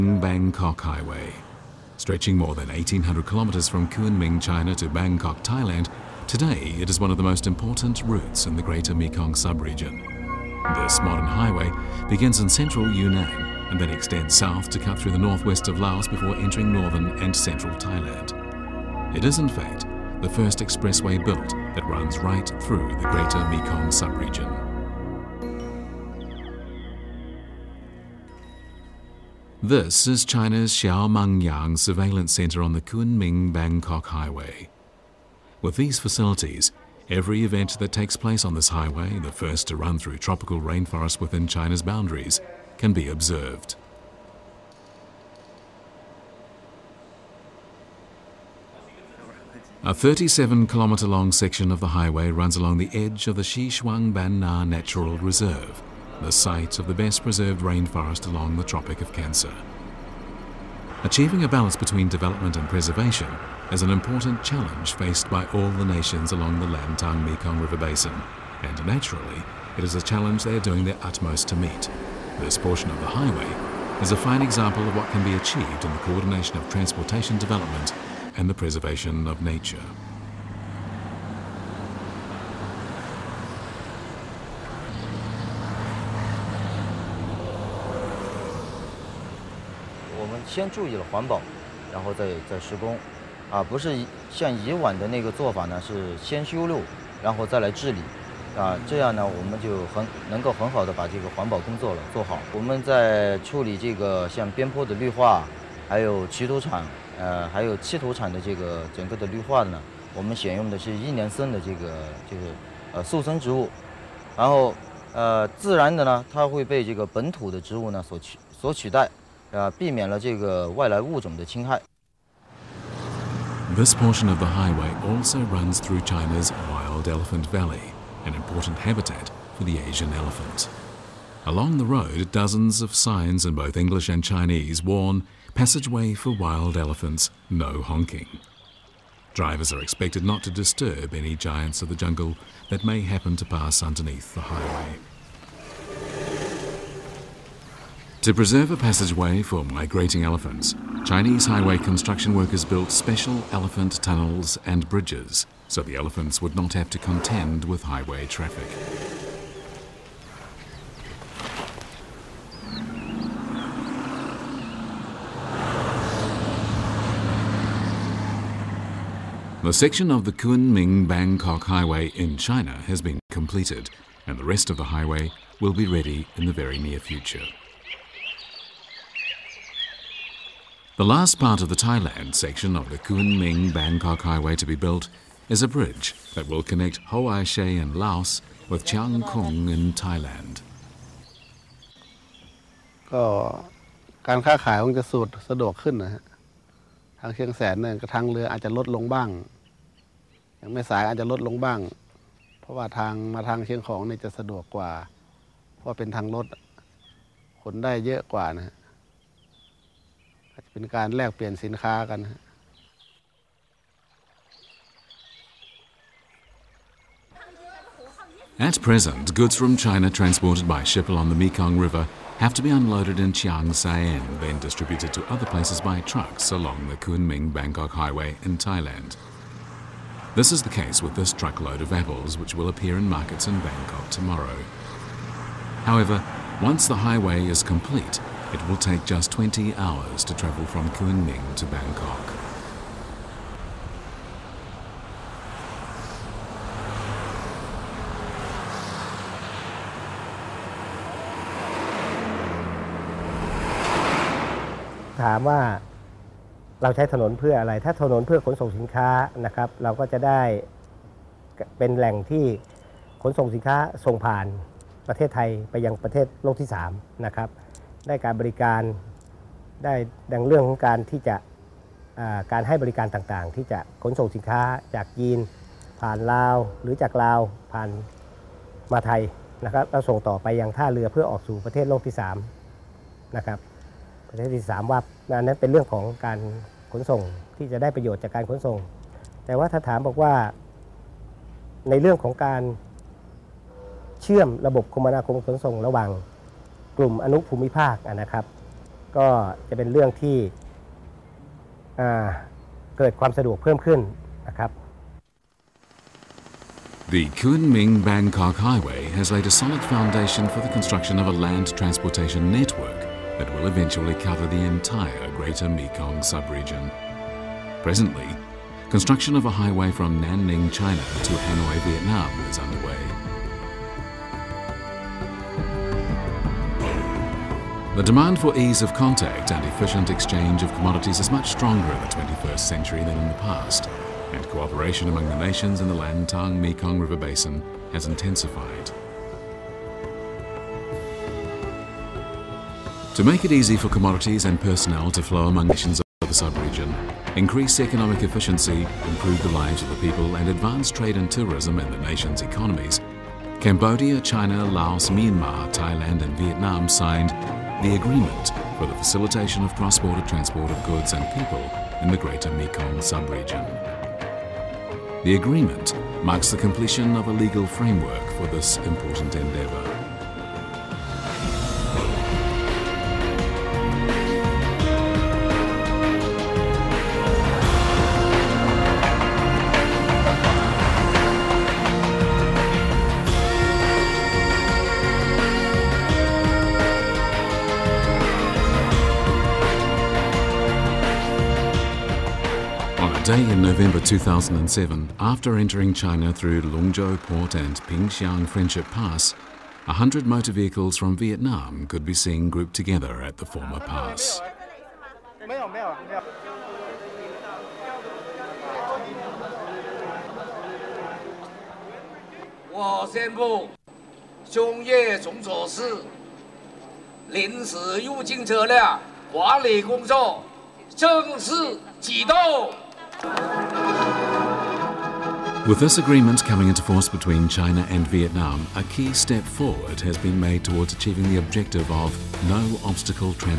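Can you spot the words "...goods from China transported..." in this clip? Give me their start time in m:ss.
3:39.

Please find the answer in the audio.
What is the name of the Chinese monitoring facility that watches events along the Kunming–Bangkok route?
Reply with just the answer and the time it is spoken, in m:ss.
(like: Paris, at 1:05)
Xiaomangyang Surveillance Center, at 0:30.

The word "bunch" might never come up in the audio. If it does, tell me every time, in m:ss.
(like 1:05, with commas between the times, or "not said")
not said.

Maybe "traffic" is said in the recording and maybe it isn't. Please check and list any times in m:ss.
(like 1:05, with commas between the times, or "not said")
2:38.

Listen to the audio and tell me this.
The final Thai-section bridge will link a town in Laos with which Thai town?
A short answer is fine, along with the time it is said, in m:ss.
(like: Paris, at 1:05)
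Chiang Kong, at 3:08.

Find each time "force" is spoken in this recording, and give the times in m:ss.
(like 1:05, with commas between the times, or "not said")
7:06.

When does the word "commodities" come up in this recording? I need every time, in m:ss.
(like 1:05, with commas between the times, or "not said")
5:30, 5:43.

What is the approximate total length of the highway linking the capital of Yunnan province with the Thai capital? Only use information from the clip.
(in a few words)
more than 1,800 kilometers.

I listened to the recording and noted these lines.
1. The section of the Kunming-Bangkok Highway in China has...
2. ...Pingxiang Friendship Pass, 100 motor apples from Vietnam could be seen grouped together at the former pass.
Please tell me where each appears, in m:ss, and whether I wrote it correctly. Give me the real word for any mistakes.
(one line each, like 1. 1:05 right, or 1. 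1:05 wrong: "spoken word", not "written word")
1. 2:49 right
2. 6:37 wrong: "vehicles", not "apples".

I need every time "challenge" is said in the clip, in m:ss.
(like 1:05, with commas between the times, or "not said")
1:04, 1:10.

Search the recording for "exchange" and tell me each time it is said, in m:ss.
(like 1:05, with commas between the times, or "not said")
5:30.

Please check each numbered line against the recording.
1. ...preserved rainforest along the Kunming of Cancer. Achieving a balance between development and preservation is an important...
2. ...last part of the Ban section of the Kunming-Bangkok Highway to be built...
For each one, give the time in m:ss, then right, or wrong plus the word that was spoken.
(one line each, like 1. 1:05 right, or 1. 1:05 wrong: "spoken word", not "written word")
1. 0:57 wrong: "Tropic", not "Kunming"
2. 3:01 wrong: "Thailand", not "Ban".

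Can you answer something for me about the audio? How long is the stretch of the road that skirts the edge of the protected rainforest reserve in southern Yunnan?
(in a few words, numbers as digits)
37 kilometers.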